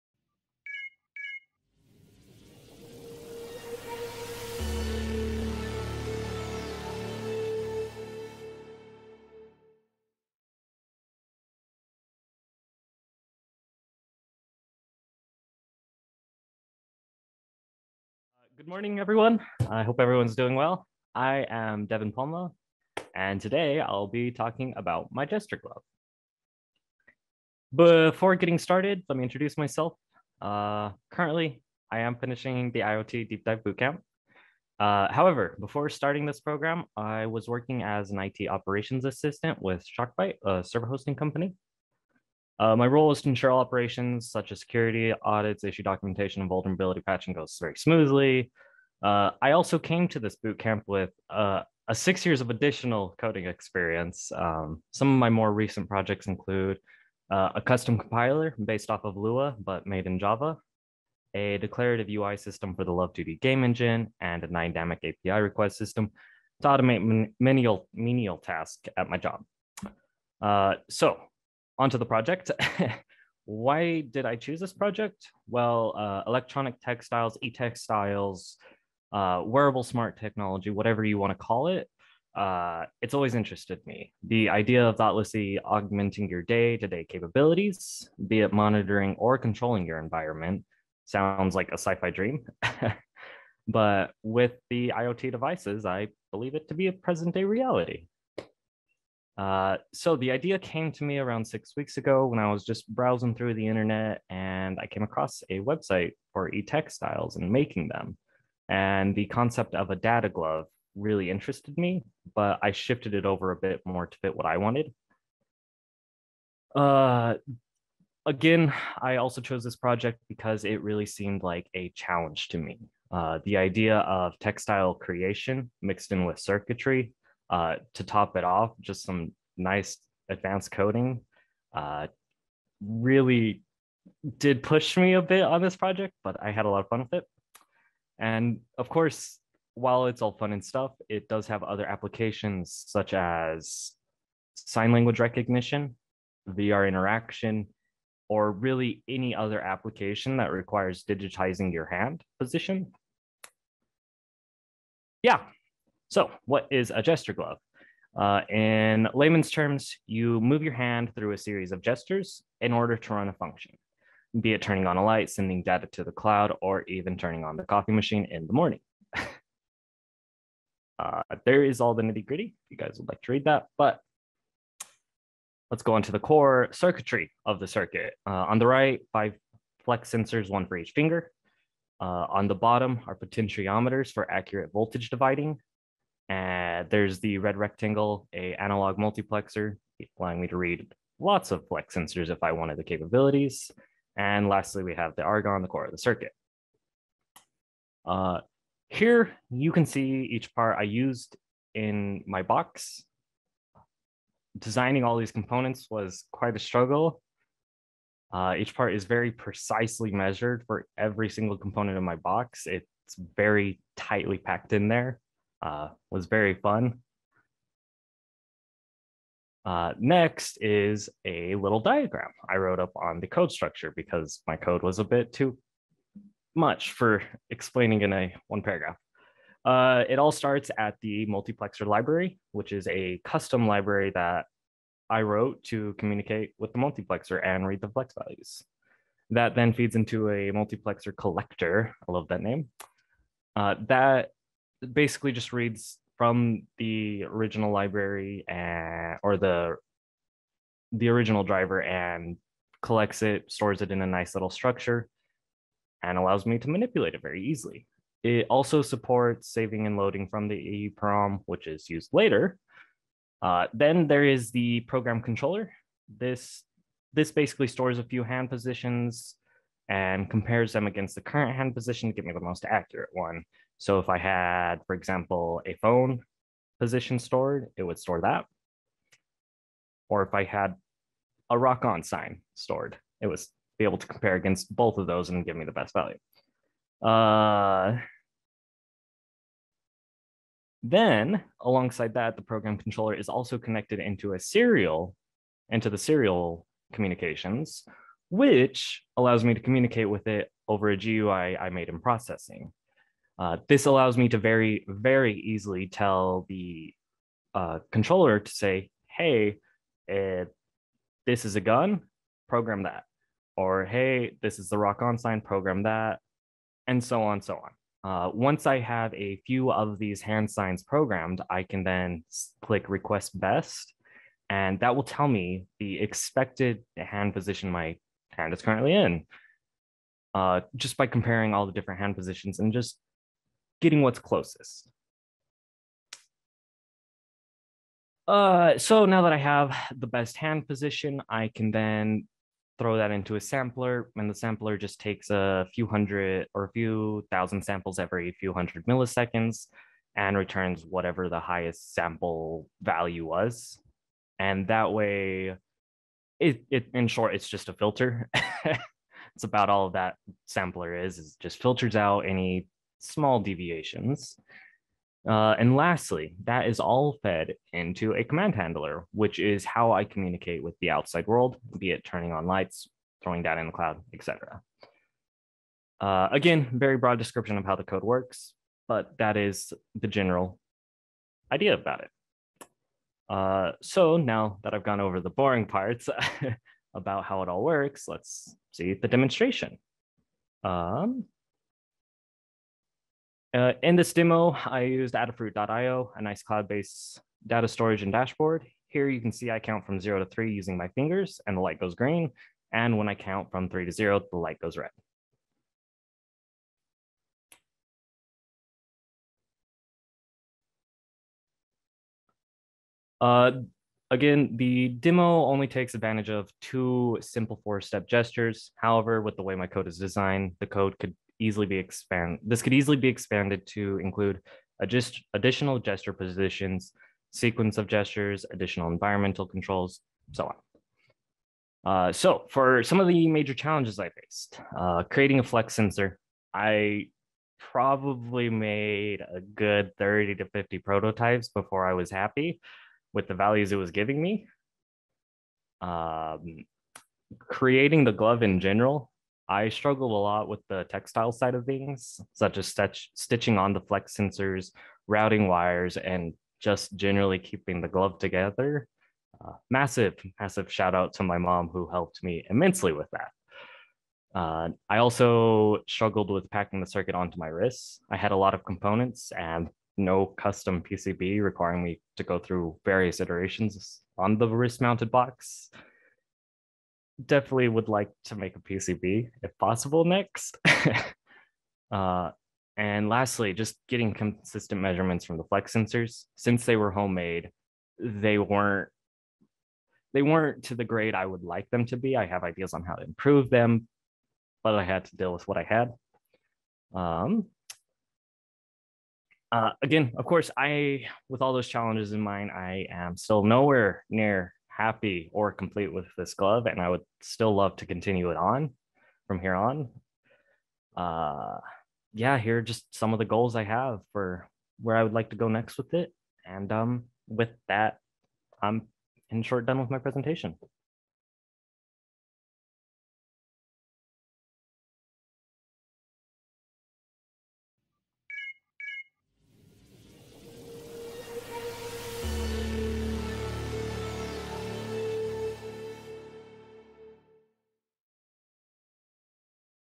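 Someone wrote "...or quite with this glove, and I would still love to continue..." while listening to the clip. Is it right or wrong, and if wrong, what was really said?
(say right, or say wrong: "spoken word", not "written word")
wrong: "complete", not "quite".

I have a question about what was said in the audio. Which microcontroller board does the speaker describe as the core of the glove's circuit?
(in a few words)
Argon.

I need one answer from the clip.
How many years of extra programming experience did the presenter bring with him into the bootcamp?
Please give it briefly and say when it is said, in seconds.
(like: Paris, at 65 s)
6, at 51 s.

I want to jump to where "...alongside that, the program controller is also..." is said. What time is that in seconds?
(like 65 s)
291 s.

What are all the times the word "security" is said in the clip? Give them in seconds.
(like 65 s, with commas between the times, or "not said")
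44 s.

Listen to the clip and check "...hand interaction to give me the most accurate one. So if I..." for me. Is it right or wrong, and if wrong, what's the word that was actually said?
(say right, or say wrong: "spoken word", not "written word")
wrong: "position", not "interaction".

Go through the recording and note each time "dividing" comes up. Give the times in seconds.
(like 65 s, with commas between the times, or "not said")
185 s.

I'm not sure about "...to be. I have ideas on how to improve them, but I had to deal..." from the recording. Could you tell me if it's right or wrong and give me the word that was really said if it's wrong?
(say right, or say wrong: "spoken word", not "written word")
right.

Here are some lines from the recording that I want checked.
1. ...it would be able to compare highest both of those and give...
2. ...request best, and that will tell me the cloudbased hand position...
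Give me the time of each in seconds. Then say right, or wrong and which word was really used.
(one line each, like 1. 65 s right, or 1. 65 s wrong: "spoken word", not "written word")
1. 283 s wrong: "against", not "highest"
2. 322 s wrong: "expected", not "cloudbased".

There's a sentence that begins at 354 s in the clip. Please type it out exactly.
And that way, it, it in short, it's just a filter.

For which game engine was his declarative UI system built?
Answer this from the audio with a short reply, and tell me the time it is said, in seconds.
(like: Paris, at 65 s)
Love2D, at 62 s.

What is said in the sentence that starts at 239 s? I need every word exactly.
That then feeds into a multiplexer collector.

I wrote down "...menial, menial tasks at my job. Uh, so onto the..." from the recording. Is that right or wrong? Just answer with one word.
right.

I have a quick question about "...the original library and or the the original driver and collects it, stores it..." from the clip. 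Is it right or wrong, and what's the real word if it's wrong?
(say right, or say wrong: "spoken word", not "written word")
right.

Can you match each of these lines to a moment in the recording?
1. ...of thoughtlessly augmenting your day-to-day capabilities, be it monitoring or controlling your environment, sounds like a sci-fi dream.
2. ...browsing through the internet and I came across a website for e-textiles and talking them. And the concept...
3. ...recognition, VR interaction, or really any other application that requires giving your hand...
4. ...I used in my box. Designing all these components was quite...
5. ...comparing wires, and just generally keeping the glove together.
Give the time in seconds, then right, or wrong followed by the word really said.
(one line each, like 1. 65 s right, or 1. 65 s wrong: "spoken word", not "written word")
1. 84 s right
2. 102 s wrong: "making", not "talking"
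3. 145 s wrong: "digitizing", not "giving"
4. 200 s right
5. 455 s wrong: "routing", not "comparing".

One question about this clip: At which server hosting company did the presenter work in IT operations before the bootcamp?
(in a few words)
ShockBite.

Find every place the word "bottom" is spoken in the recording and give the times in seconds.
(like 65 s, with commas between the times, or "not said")
182 s.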